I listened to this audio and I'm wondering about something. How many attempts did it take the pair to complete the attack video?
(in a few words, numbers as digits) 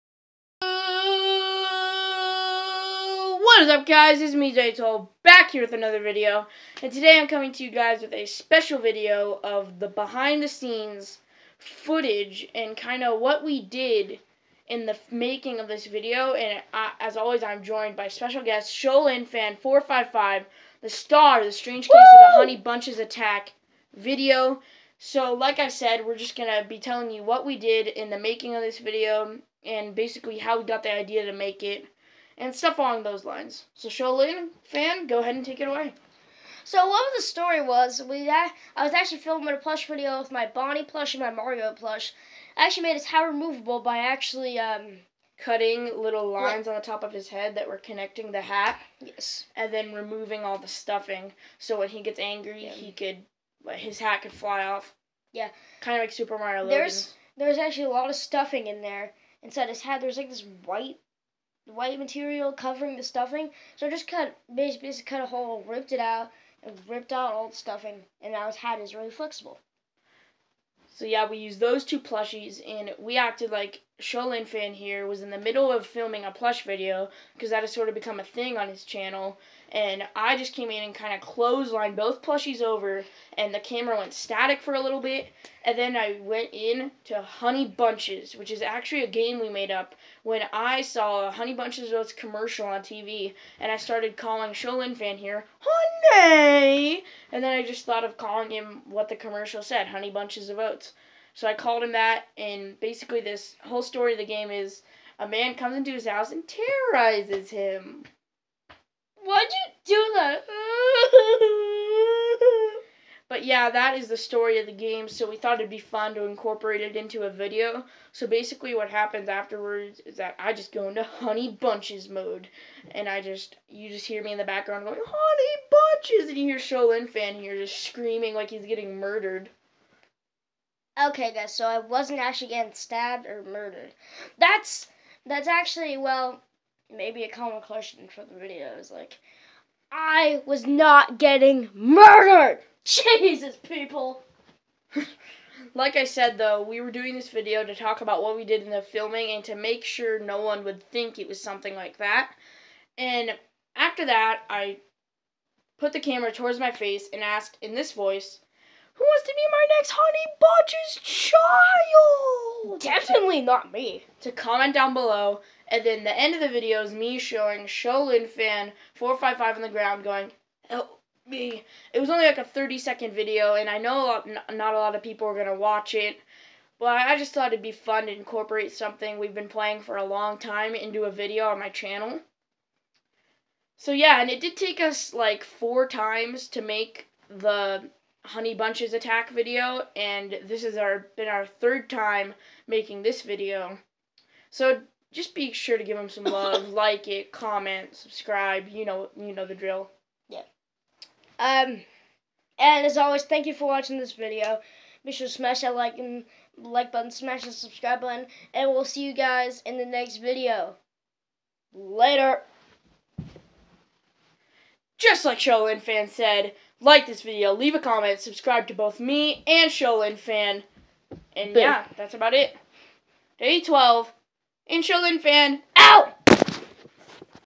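4.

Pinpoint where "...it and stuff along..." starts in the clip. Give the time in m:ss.
0:31.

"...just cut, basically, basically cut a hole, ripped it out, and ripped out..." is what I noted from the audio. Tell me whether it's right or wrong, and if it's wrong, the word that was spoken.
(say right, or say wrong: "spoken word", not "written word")
right.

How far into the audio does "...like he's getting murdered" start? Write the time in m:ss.
2:08.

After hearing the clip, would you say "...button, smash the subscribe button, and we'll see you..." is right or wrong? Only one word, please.
right.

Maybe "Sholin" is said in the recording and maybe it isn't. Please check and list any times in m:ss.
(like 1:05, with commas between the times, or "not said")
0:18, 0:33, 1:14, 1:34, 2:06, 2:47, 3:39, 3:44.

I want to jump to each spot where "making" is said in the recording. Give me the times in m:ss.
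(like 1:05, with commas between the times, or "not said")
0:15, 0:28, 3:12.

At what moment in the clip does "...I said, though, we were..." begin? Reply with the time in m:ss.
2:25.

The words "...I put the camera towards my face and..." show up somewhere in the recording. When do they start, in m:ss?
2:34.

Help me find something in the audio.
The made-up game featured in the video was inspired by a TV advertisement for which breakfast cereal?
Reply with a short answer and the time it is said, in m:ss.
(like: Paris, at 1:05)
Honey Bunches of Oats, at 1:31.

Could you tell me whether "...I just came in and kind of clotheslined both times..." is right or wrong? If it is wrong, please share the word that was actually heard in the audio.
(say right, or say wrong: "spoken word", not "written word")
wrong: "plushies", not "times".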